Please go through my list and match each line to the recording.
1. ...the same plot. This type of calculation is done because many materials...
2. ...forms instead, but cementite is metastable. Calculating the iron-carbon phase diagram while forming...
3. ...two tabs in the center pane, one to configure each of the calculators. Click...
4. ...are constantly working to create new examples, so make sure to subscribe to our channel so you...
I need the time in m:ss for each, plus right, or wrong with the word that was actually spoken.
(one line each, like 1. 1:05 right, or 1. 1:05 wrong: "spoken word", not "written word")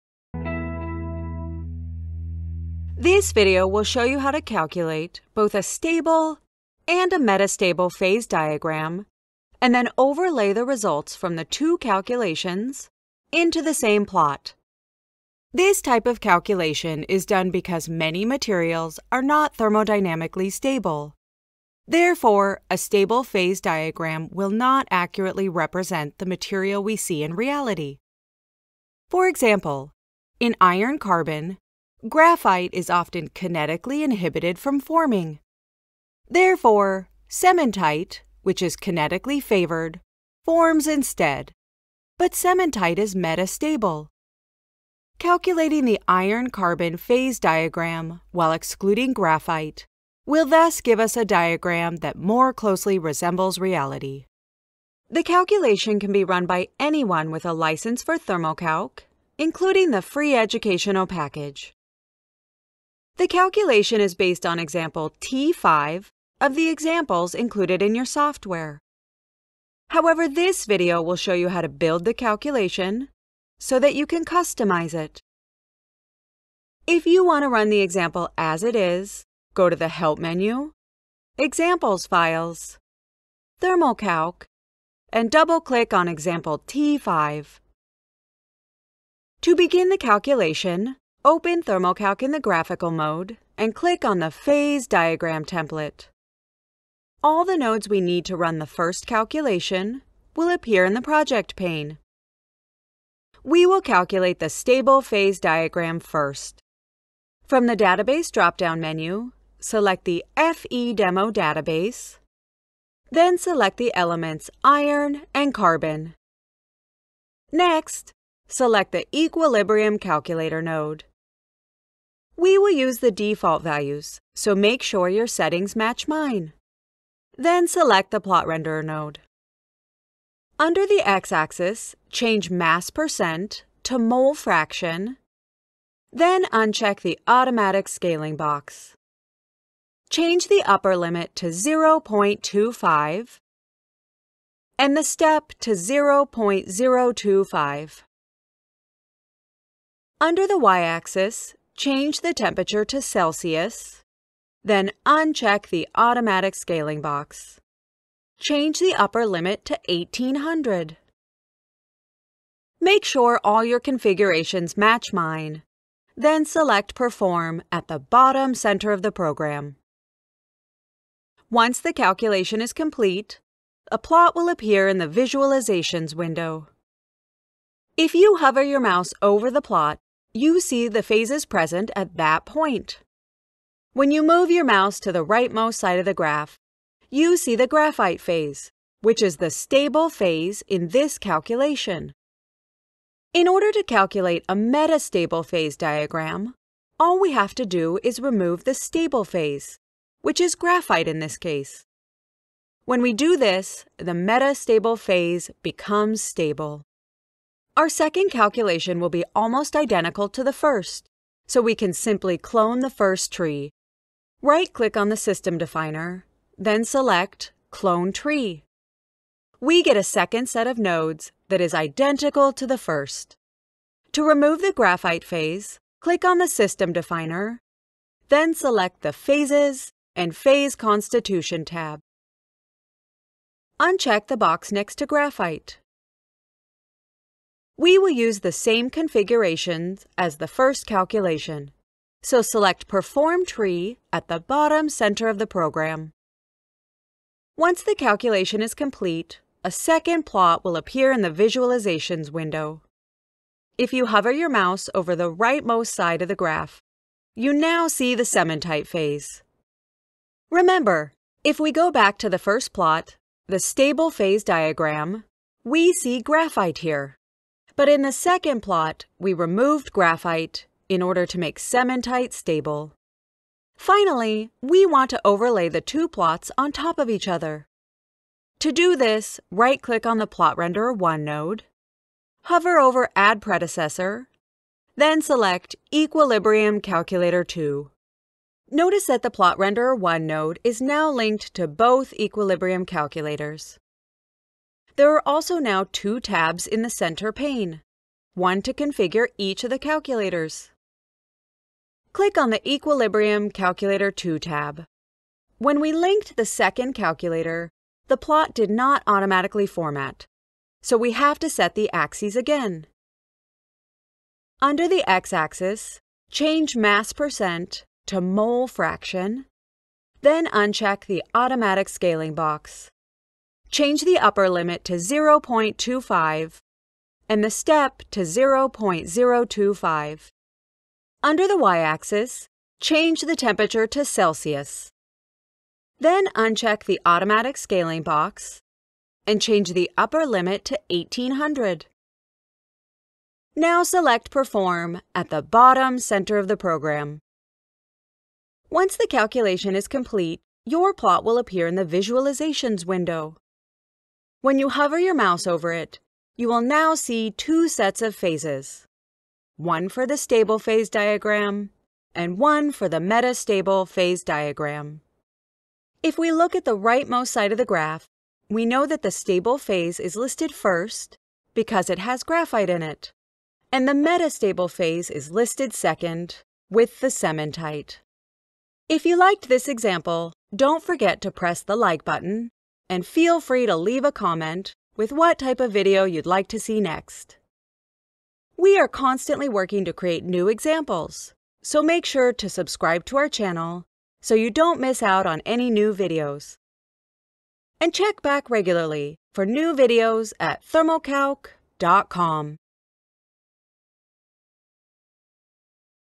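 1. 0:13 right
2. 0:40 wrong: "excluding", not "forming"
3. 4:55 right
4. 6:28 right.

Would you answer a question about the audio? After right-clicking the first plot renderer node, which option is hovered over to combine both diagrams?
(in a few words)
Add Predecessor.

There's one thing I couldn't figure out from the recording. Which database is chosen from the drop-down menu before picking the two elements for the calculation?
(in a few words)
FE Demo.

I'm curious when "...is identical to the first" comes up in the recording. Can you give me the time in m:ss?
3:41.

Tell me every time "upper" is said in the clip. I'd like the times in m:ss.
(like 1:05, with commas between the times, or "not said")
2:20, 2:38, 5:24, 5:39.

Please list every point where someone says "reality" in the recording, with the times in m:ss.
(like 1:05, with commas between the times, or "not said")
0:27, 0:53.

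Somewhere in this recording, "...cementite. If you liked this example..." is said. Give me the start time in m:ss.
6:17.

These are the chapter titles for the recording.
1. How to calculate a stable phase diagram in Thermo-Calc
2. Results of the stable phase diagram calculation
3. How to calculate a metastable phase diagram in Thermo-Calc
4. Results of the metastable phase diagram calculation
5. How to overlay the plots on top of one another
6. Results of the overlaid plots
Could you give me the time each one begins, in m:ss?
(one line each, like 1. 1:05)
1. 1:29
2. 2:51
3. 3:13
4. 4:07
5. 4:34
6. 5:49.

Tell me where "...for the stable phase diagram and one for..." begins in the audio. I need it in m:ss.
5:59.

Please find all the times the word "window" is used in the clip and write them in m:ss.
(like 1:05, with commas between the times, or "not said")
2:56, 4:12, 5:52.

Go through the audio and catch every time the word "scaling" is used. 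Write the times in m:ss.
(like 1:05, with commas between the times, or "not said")
2:17, 2:36, 5:21, 5:37.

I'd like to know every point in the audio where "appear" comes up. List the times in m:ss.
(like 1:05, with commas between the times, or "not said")
1:40, 2:54, 4:10, 5:51.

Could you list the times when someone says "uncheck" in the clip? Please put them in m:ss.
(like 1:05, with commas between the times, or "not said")
2:16, 2:35, 3:53, 5:20, 5:36.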